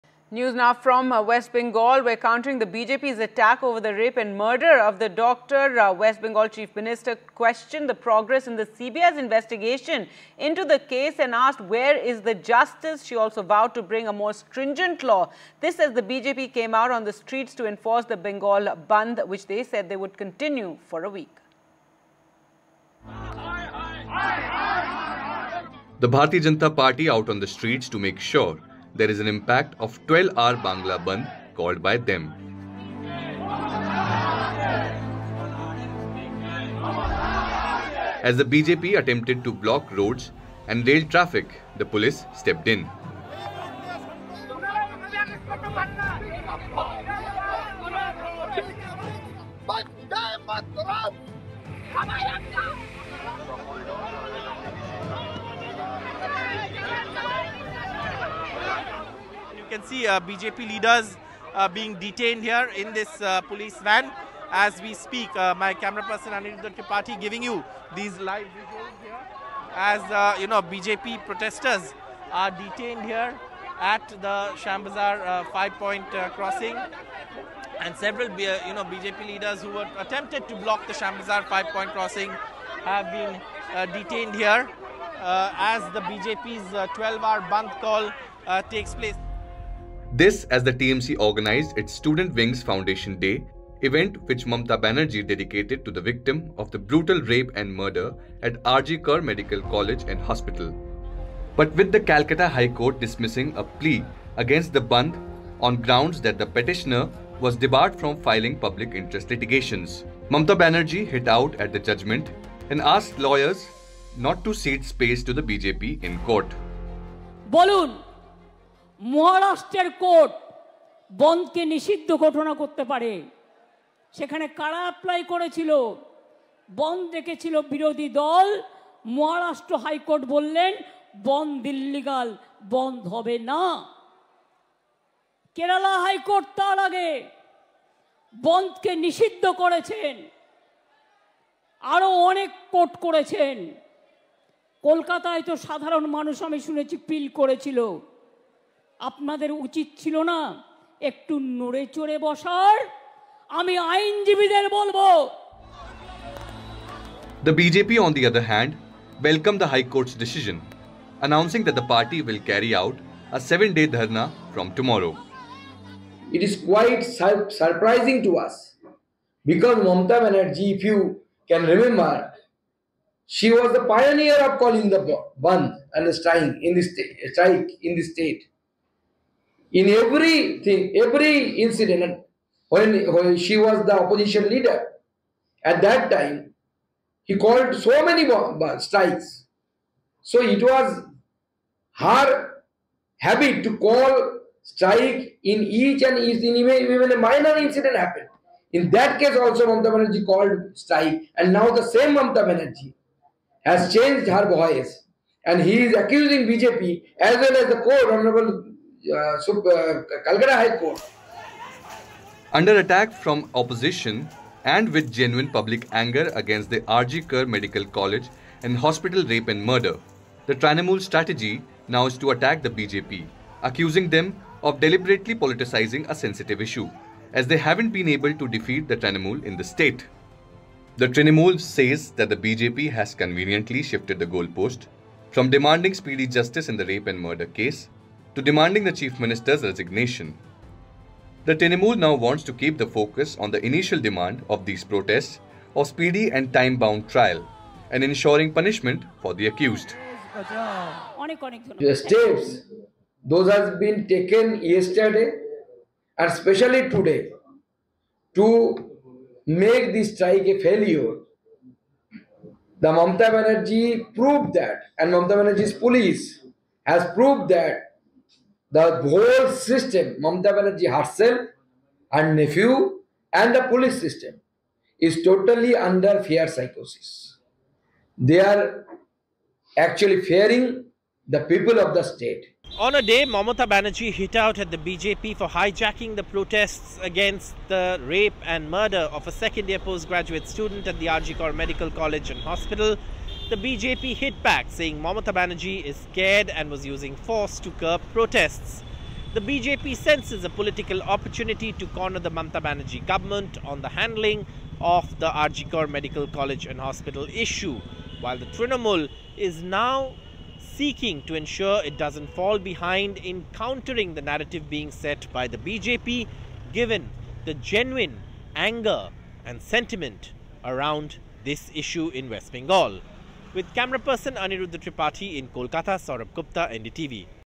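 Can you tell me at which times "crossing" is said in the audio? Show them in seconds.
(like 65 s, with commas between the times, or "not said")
76 s, 81 s.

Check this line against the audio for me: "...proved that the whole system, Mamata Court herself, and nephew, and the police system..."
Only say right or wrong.
wrong.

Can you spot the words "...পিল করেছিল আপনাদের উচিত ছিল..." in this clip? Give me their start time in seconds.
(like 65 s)
147 s.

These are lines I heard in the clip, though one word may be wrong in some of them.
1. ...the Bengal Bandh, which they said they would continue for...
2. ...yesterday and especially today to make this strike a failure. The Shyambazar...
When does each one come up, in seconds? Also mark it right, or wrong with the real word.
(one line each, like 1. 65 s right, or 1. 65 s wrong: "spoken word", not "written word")
1. 18 s right
2. 254 s wrong: "Mamata", not "Shyambazar".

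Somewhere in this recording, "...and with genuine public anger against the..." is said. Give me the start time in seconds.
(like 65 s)
214 s.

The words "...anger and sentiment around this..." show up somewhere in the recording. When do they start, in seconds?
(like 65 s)
318 s.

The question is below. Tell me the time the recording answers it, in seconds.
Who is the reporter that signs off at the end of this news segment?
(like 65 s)
325 s.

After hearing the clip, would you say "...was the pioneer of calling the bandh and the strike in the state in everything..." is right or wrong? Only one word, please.
right.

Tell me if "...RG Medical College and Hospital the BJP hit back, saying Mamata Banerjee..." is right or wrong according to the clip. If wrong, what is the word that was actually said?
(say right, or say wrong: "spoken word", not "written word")
right.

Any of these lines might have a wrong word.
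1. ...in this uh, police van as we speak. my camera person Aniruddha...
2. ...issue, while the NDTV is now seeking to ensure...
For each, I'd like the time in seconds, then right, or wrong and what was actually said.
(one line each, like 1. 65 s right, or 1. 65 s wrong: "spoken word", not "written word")
1. 62 s right
2. 307 s wrong: "Trinamool", not "NDTV".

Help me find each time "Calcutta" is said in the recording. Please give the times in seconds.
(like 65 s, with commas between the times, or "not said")
102 s, 209 s.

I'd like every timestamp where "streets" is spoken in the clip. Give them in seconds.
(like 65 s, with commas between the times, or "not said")
17 s, 27 s.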